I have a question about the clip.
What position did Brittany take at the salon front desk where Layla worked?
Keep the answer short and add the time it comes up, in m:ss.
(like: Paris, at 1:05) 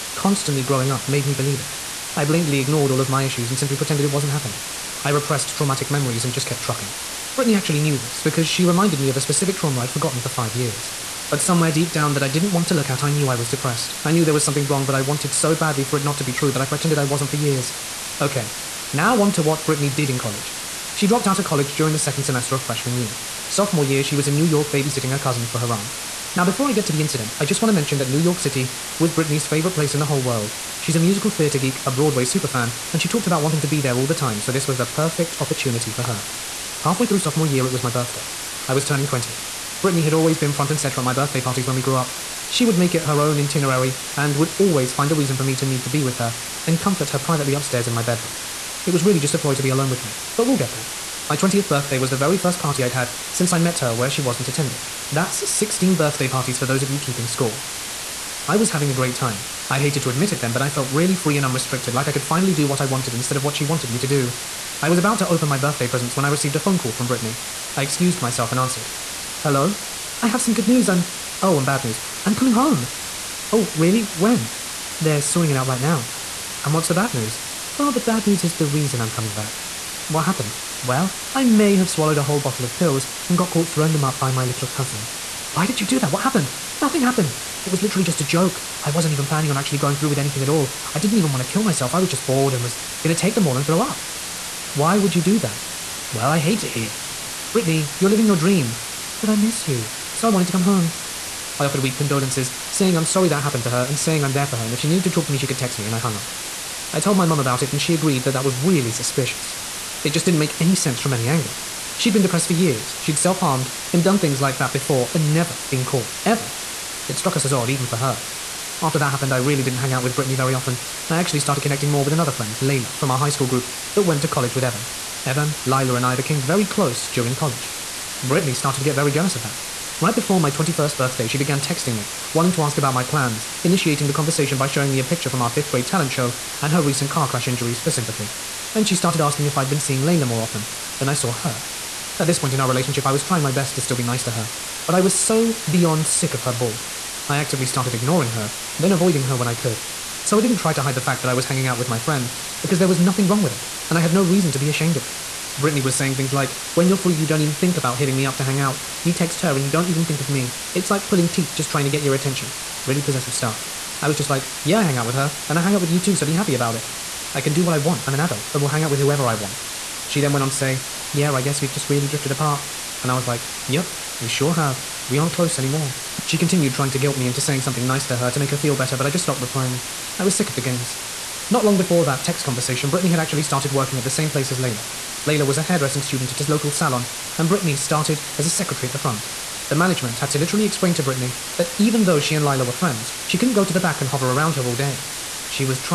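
Secretary, at 3:08.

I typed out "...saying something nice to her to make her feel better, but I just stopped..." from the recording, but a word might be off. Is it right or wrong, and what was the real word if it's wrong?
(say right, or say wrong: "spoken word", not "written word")
right.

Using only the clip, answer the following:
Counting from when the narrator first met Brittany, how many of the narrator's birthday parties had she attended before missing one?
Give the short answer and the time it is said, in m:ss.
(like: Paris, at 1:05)
16, at 0:55.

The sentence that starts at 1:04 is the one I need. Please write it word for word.
I was about to open my birthday presents when I received a phone call from Brittany.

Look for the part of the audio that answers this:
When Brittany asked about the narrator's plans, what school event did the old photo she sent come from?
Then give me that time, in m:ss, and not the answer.
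2:15.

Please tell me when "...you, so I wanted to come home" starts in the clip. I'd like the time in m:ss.
1:39.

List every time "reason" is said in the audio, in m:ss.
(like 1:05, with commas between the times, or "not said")
0:45, 1:18, 2:34.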